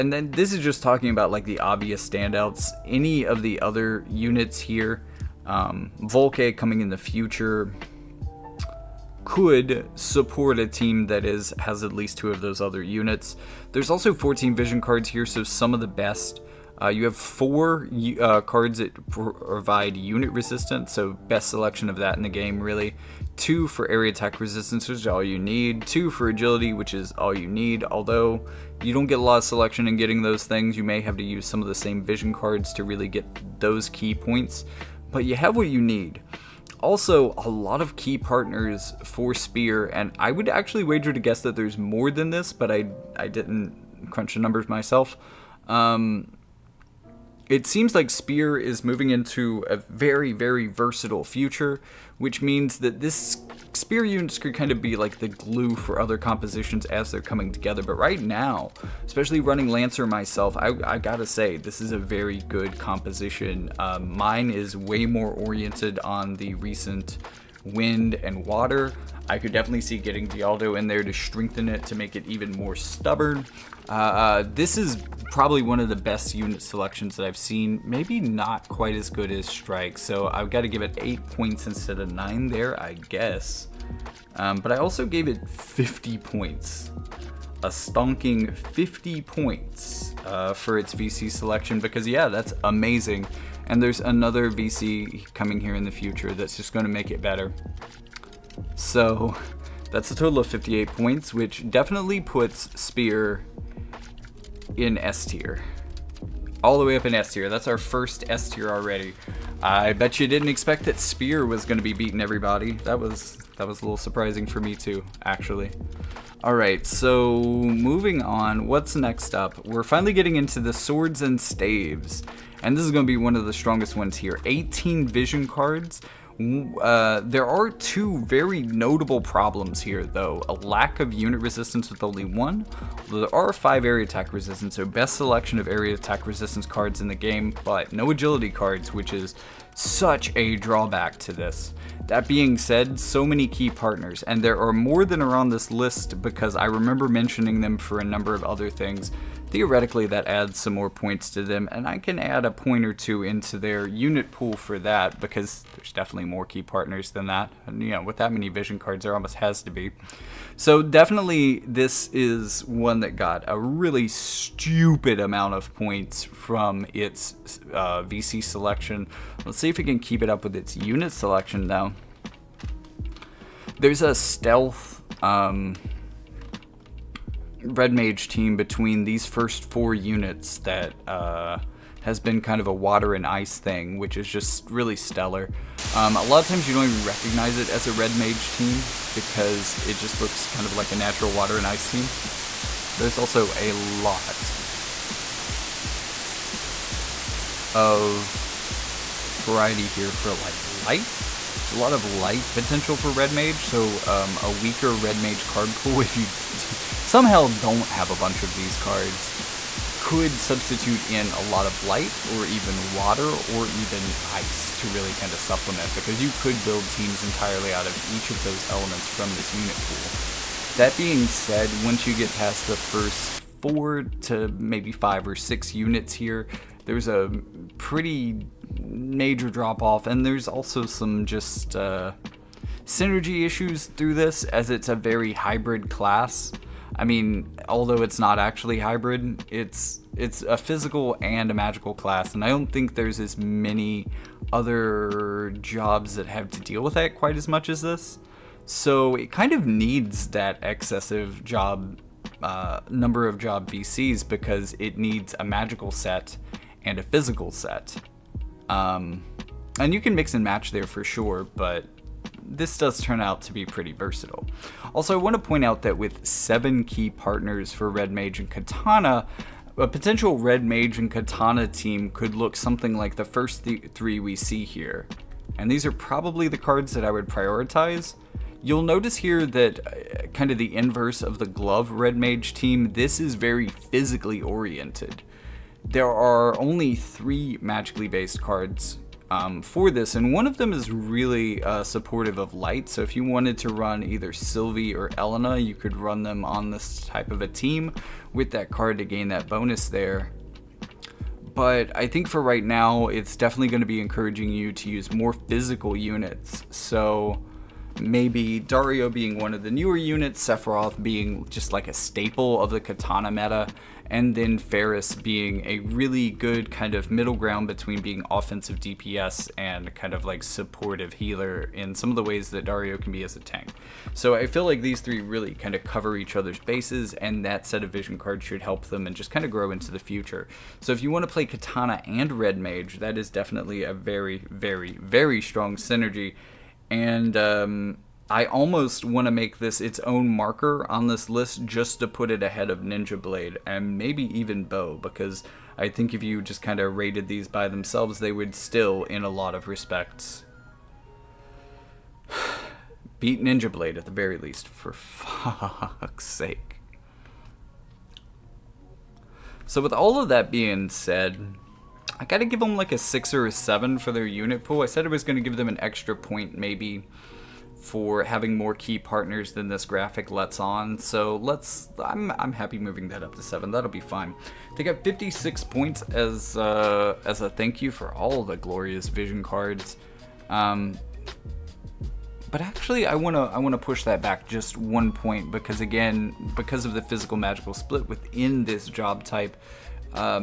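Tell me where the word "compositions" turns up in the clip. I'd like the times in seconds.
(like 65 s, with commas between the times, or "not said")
56 s, 62 s.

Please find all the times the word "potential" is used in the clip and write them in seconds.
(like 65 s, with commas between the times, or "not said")
202 s, 269 s.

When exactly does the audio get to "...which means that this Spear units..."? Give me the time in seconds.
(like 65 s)
52 s.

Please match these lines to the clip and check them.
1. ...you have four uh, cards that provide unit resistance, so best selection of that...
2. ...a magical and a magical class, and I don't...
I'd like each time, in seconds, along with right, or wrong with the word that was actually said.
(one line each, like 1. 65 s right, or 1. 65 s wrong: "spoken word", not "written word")
1. 16 s right
2. 240 s wrong: "physical", not "magical".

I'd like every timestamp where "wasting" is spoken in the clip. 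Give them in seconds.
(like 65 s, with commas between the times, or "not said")
not said.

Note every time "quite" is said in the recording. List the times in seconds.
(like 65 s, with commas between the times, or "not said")
78 s, 247 s.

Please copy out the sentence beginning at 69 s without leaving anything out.
I could definitely see getting Dialdo in there to strengthen it to make it even more stubborn.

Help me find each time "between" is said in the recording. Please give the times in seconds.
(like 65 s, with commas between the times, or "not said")
178 s, 317 s.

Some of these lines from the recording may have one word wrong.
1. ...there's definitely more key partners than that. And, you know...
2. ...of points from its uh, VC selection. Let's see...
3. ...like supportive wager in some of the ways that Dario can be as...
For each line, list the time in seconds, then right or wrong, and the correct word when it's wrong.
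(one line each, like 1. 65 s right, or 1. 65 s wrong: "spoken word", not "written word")
1. 155 s right
2. 165 s right
3. 320 s wrong: "healer", not "wager".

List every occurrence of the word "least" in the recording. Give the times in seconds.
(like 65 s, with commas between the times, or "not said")
11 s, 354 s.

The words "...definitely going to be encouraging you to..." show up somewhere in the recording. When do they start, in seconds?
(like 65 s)
303 s.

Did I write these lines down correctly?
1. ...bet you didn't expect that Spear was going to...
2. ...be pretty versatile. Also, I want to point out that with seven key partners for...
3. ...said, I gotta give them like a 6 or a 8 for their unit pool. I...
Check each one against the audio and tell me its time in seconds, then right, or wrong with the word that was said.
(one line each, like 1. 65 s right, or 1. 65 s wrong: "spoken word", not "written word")
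1. 109 s right
2. 263 s right
3. 360 s wrong: "7", not "8".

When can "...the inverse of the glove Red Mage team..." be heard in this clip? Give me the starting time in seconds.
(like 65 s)
280 s.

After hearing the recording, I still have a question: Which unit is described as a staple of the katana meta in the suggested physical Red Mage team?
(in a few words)
Sephiroth.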